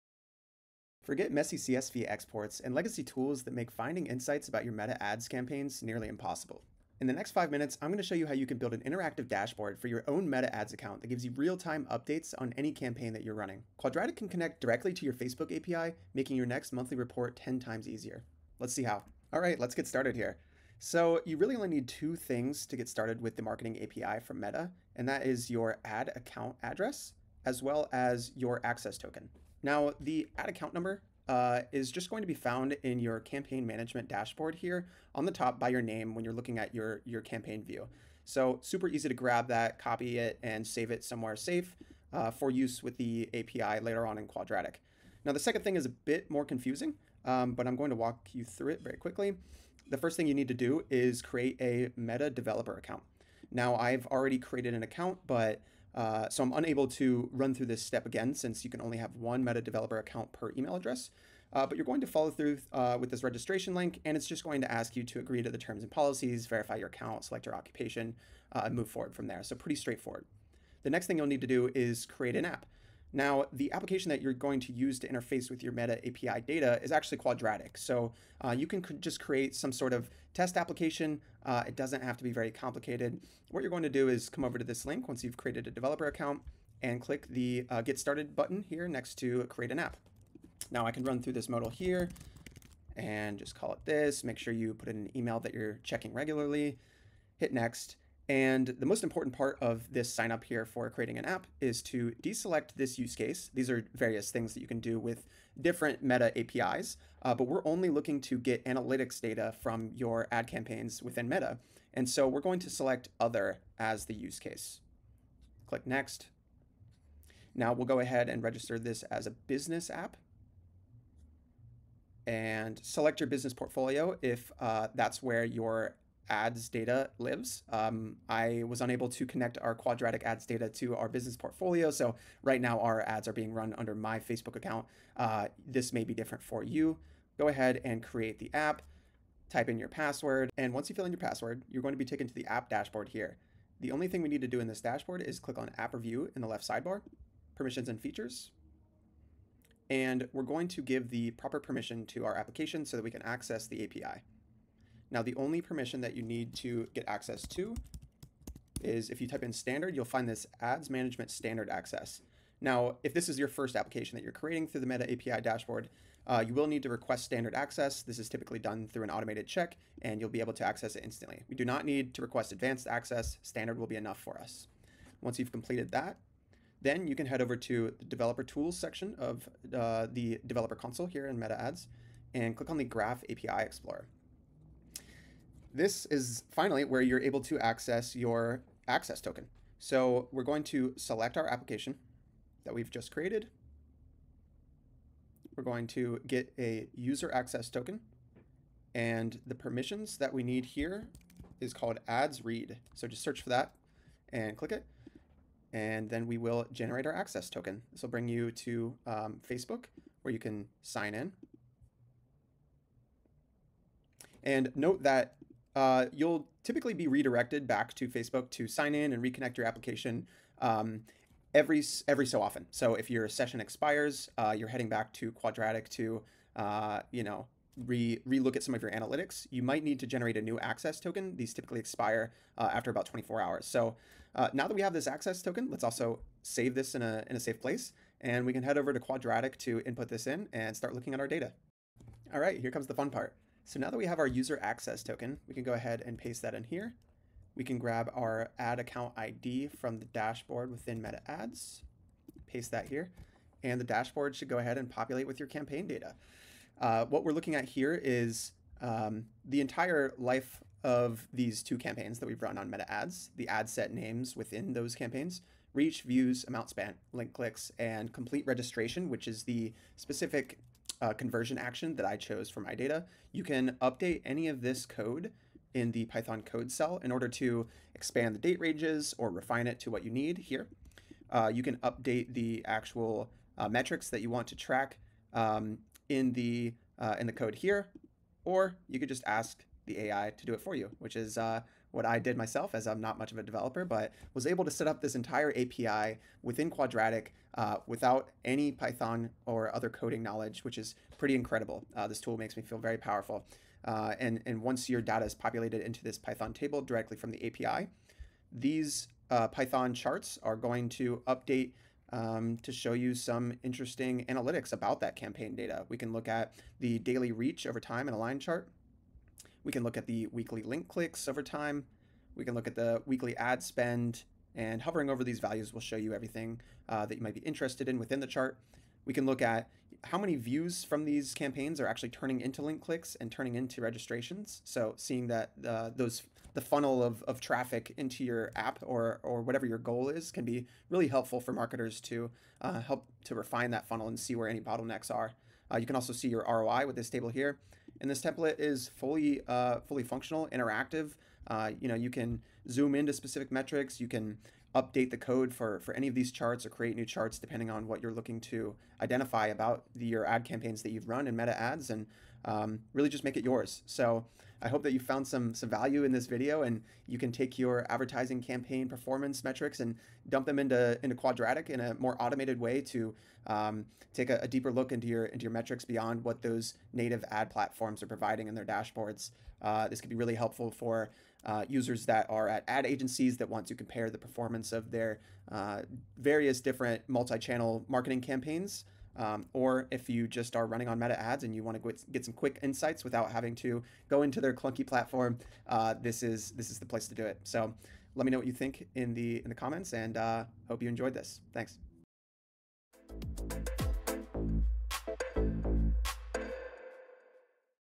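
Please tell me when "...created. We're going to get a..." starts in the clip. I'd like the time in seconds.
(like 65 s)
193 s.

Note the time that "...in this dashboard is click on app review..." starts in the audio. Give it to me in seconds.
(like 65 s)
144 s.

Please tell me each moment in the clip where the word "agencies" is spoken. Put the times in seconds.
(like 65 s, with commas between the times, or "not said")
382 s.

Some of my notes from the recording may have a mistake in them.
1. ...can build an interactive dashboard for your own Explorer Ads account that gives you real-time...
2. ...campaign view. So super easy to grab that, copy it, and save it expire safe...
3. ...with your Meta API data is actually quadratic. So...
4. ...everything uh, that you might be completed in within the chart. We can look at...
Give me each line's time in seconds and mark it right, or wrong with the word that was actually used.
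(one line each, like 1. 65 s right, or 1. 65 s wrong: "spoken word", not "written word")
1. 8 s wrong: "Meta", not "Explorer"
2. 37 s wrong: "somewhere", not "expire"
3. 75 s right
4. 326 s wrong: "interested", not "completed".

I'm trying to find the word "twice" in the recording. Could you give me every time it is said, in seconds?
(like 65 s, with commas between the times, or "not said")
not said.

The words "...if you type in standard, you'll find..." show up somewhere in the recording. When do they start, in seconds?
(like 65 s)
159 s.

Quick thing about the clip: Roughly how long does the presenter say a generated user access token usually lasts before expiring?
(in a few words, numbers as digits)
24 hours.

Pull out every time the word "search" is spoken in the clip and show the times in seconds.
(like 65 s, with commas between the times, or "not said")
203 s.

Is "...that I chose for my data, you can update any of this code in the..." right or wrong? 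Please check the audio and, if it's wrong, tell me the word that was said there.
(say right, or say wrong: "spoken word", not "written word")
right.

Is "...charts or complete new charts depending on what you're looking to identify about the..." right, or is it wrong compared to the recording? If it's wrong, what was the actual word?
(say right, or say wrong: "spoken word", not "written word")
wrong: "create", not "complete".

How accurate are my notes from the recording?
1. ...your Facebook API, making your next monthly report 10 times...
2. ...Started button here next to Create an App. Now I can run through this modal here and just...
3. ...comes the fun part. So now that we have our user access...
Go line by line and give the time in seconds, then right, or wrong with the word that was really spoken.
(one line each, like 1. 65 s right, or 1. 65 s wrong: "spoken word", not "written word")
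1. 15 s right
2. 87 s right
3. 242 s right.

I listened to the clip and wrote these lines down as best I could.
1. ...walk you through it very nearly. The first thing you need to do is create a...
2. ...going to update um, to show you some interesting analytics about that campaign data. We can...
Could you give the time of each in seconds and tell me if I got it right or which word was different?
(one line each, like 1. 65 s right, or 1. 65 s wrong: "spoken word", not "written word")
1. 47 s wrong: "quickly", not "nearly"
2. 310 s right.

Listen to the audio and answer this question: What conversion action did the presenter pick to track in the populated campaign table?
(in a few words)
Complete registration.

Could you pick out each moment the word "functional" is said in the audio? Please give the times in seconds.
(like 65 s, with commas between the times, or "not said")
350 s.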